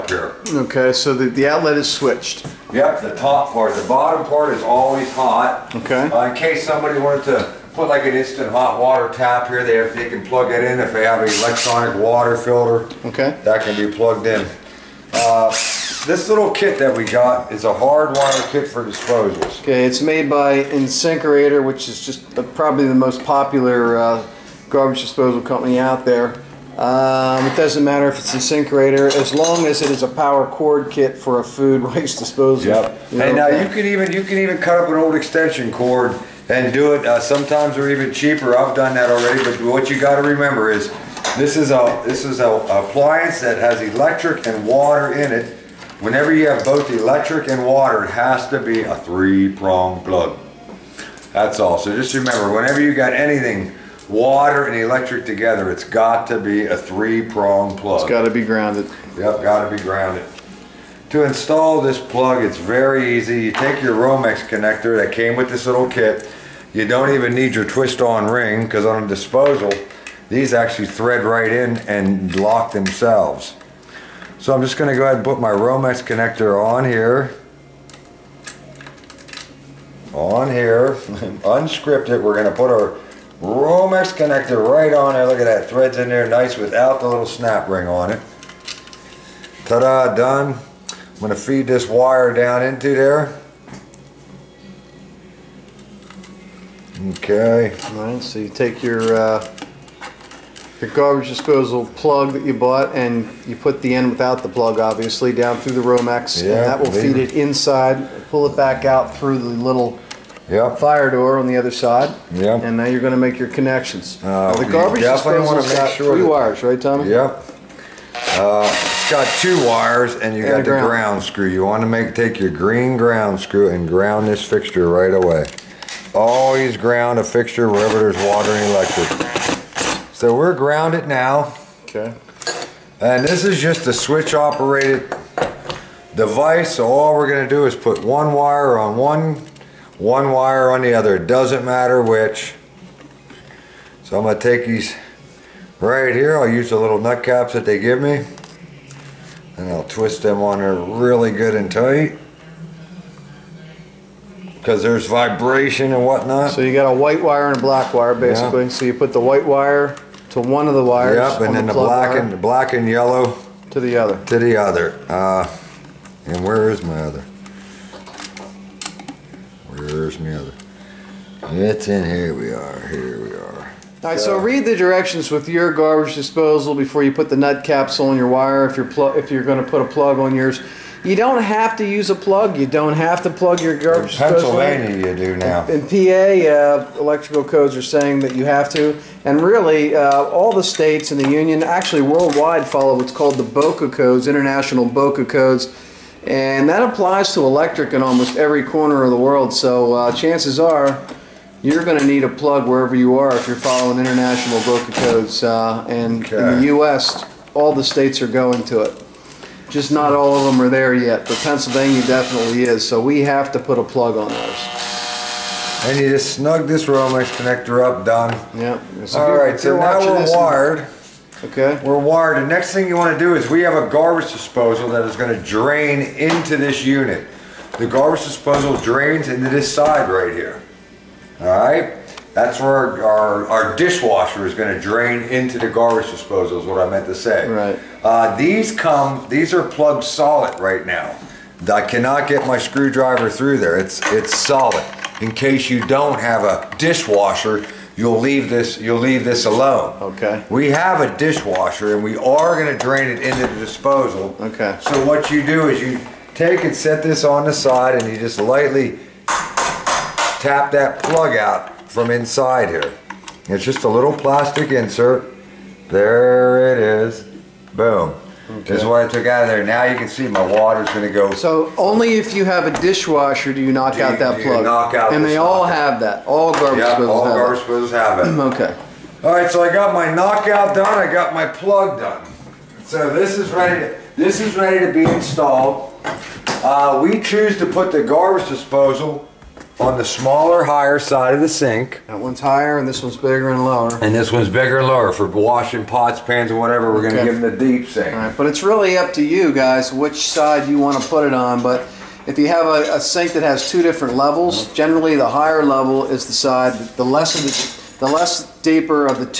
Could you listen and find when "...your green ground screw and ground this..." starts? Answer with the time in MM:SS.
02:02.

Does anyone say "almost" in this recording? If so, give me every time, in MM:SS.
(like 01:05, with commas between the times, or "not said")
03:18.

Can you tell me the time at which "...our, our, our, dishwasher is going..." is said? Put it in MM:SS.
03:53.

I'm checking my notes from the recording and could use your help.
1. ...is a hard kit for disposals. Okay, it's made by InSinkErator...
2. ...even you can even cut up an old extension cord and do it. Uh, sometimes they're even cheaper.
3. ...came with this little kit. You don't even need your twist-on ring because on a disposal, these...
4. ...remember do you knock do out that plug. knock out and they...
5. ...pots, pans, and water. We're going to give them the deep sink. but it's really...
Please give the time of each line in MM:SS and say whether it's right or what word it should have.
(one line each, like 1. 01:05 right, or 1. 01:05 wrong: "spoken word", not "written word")
1. 00:17 right
2. 00:33 right
3. 01:05 right
4. 04:32 wrong: "dishwasher", not "remember"
5. 04:55 wrong: "whatever", not "water".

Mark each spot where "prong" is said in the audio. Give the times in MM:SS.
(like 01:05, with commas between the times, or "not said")
00:48, 00:56.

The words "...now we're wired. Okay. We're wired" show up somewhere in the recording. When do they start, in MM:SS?
03:39.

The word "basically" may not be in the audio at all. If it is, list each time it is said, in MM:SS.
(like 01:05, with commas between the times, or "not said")
02:38.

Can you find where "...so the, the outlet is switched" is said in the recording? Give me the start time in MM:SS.
00:00.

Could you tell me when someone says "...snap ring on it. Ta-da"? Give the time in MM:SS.
01:27.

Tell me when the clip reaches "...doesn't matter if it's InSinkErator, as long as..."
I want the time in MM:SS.
00:27.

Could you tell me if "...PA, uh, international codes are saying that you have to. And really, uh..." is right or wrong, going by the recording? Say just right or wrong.
wrong.